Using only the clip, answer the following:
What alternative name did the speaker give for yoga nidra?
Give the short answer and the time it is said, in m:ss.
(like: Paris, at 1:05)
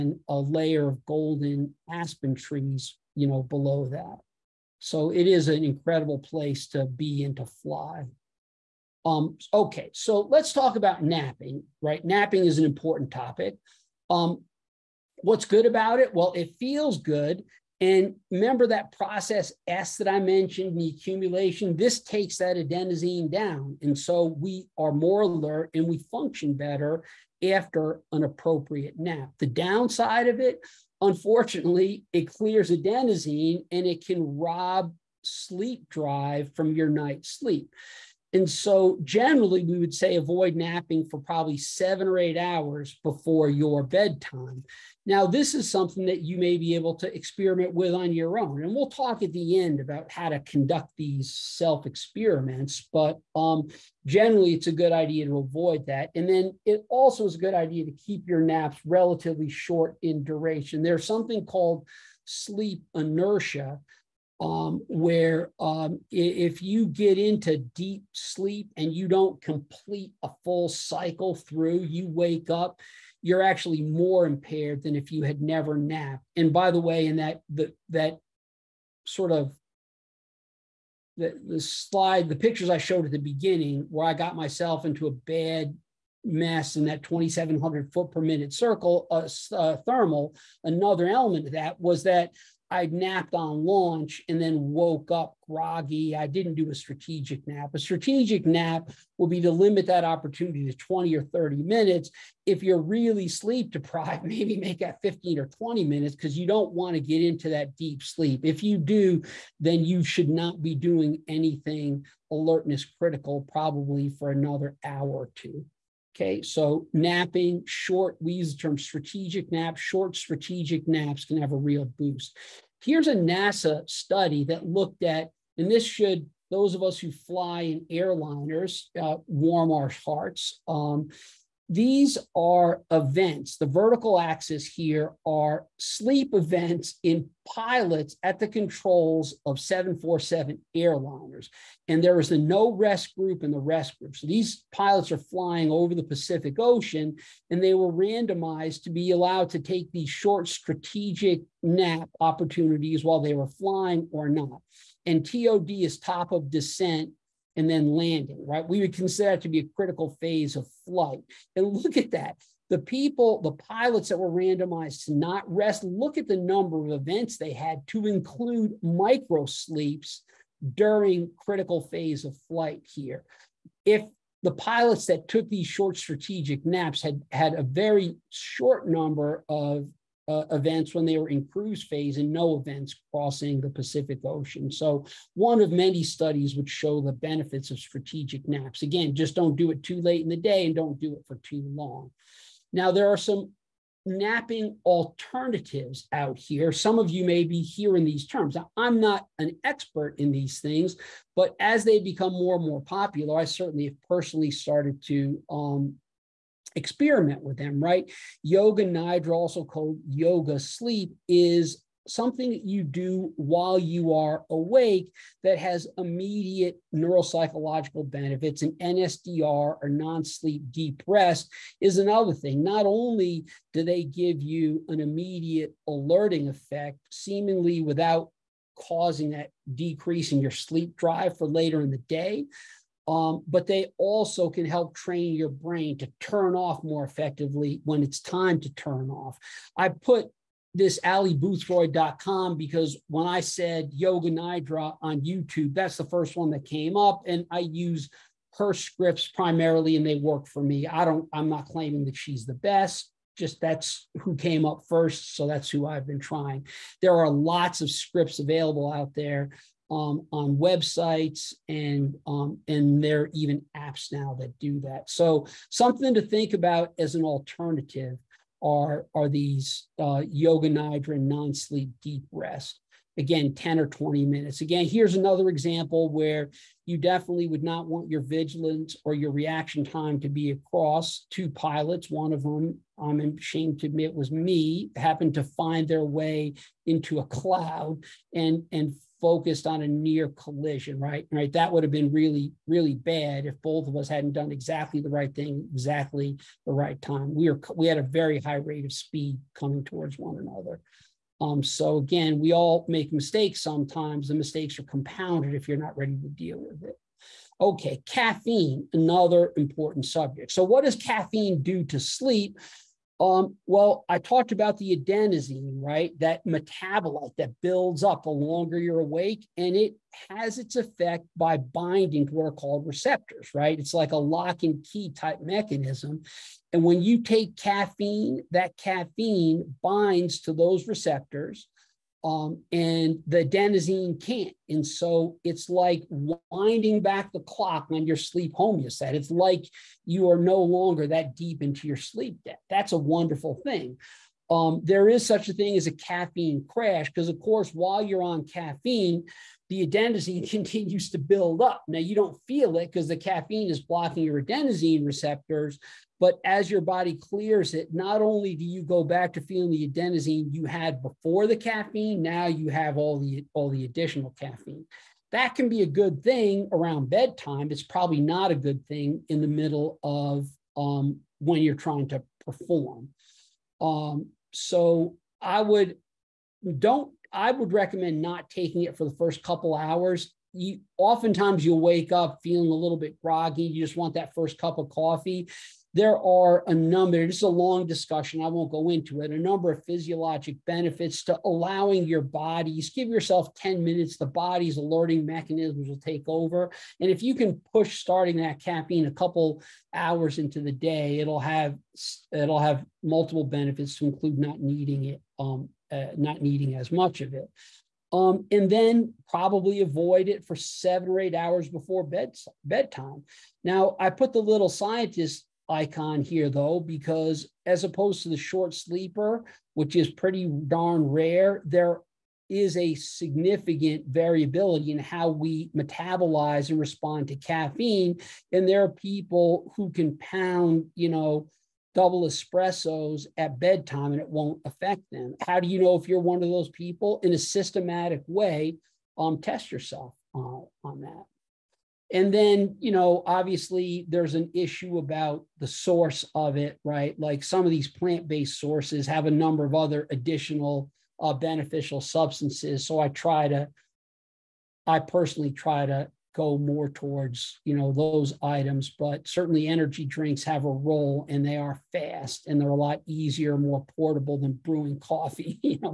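Yoga sleep, at 3:30.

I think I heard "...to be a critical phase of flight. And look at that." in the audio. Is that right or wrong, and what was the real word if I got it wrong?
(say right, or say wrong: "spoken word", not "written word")
right.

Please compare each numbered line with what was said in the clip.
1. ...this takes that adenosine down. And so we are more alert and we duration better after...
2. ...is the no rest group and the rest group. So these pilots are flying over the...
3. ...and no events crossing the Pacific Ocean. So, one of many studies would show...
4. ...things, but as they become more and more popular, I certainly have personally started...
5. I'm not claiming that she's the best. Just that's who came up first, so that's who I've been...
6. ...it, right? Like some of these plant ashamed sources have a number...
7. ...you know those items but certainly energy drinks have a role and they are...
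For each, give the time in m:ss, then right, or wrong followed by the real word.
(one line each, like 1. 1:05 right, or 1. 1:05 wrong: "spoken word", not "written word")
1. 0:21 wrong: "function", not "duration"
2. 2:22 right
3. 3:02 right
4. 3:20 right
5. 4:11 right
6. 7:26 wrong: "based", not "ashamed"
7. 7:37 right.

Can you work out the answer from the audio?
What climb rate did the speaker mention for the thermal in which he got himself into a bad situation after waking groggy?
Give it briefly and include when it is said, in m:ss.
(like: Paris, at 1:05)
2,700 feet per minute, at 1:27.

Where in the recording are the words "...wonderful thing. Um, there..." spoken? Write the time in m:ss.
5:42.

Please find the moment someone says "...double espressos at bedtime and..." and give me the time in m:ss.
7:11.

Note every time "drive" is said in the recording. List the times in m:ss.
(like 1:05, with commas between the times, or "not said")
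0:35, 3:50.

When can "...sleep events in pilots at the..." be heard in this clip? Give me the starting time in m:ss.
2:15.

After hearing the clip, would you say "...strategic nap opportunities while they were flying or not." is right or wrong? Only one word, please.
right.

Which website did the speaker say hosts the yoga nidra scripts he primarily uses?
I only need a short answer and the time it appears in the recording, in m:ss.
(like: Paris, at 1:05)
allyboothroyd.com, at 4:01.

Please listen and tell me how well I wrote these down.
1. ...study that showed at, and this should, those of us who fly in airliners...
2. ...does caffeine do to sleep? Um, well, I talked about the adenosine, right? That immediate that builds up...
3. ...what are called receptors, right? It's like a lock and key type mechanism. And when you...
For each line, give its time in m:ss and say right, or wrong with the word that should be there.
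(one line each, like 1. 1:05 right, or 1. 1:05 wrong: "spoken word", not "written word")
1. 2:03 wrong: "looked", not "showed"
2. 5:10 wrong: "metabolite", not "immediate"
3. 5:22 right.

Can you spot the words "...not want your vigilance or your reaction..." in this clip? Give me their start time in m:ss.
4:37.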